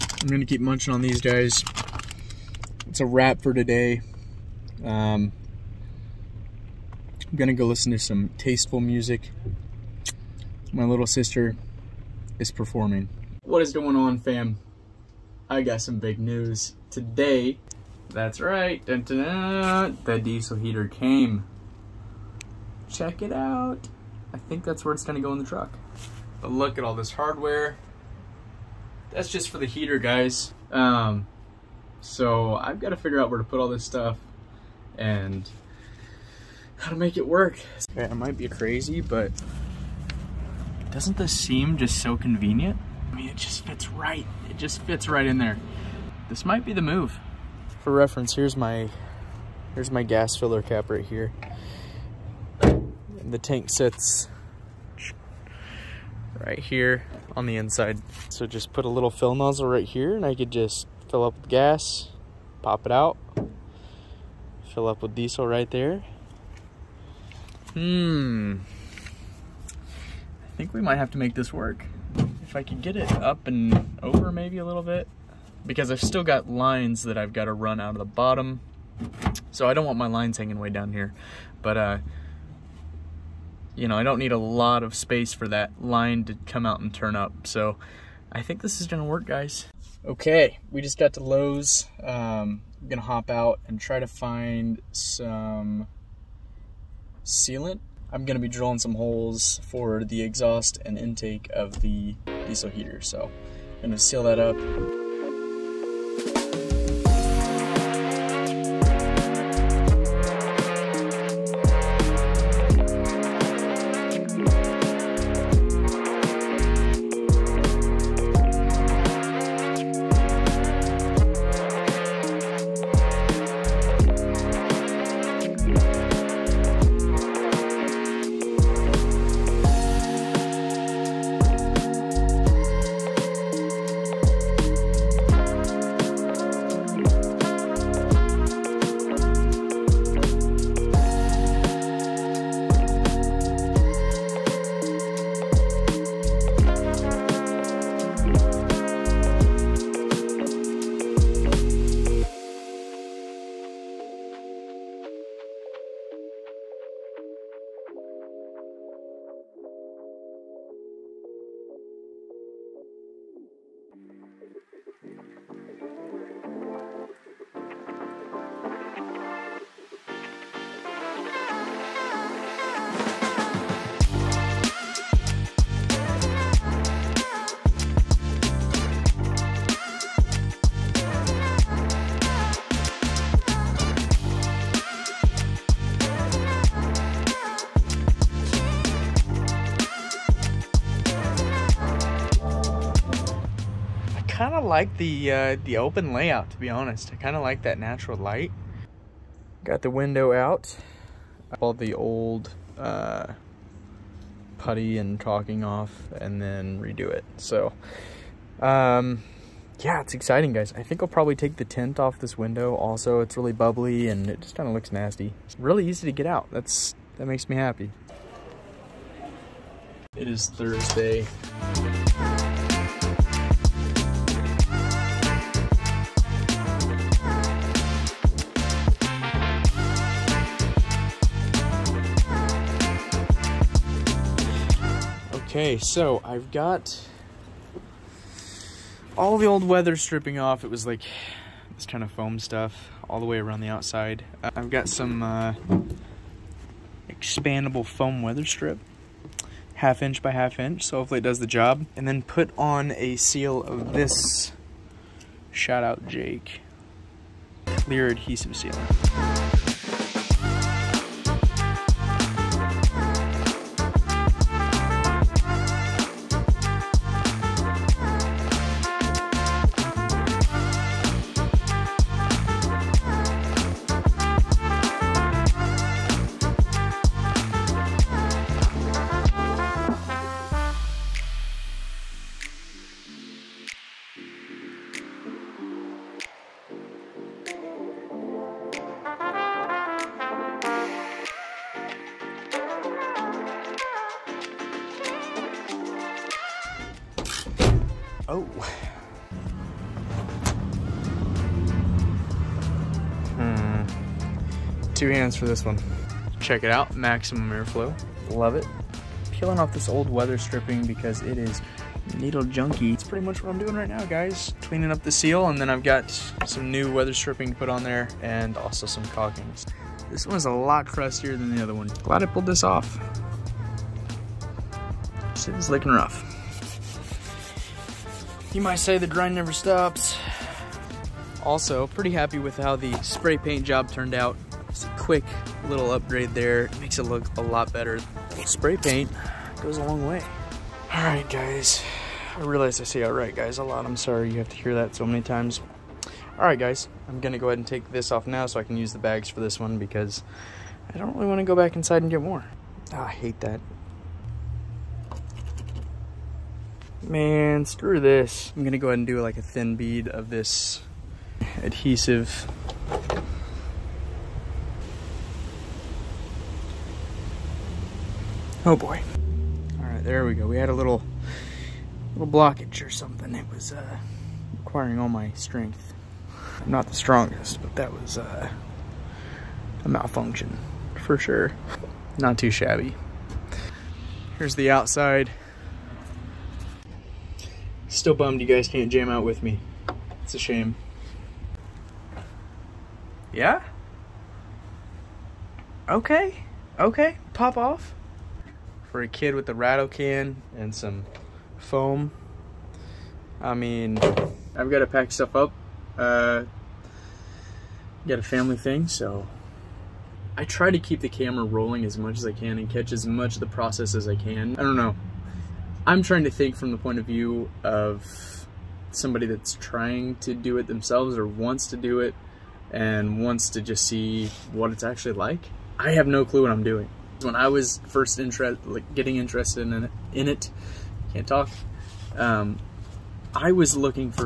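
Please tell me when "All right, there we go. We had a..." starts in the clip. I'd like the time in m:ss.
6:09.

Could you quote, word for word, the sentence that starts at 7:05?
I have no clue what I'm doing when I was first interest, like getting interested in it, in it can't talk.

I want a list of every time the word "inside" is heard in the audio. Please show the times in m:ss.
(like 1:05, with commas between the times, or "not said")
0:57, 5:51.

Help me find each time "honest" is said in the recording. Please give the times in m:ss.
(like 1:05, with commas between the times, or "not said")
3:16.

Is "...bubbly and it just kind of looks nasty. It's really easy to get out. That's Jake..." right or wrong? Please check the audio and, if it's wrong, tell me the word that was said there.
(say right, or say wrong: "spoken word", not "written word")
wrong: "That", not "Jake".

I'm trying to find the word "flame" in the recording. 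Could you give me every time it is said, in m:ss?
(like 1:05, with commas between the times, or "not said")
not said.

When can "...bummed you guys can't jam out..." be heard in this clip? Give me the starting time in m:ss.
6:28.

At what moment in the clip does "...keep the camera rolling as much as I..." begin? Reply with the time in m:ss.
6:50.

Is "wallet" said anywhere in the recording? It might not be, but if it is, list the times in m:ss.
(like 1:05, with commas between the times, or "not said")
not said.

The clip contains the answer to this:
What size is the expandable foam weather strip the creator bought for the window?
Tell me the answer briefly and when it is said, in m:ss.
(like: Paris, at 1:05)
half inch by half inch, at 4:09.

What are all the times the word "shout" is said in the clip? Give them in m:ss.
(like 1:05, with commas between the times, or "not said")
4:15.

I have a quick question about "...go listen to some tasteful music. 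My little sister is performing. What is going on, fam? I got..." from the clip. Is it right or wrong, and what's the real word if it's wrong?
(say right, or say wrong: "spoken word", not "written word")
right.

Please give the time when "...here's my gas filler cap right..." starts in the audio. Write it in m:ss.
0:49.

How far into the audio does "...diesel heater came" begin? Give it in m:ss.
0:20.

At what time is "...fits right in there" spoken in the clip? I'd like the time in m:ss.
0:44.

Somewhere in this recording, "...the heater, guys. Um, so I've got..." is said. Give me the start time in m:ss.
0:29.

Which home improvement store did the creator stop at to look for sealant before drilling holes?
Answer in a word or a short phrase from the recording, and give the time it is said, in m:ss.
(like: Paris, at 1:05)
Lowe's, at 1:31.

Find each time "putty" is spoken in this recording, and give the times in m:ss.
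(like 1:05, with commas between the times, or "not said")
3:24.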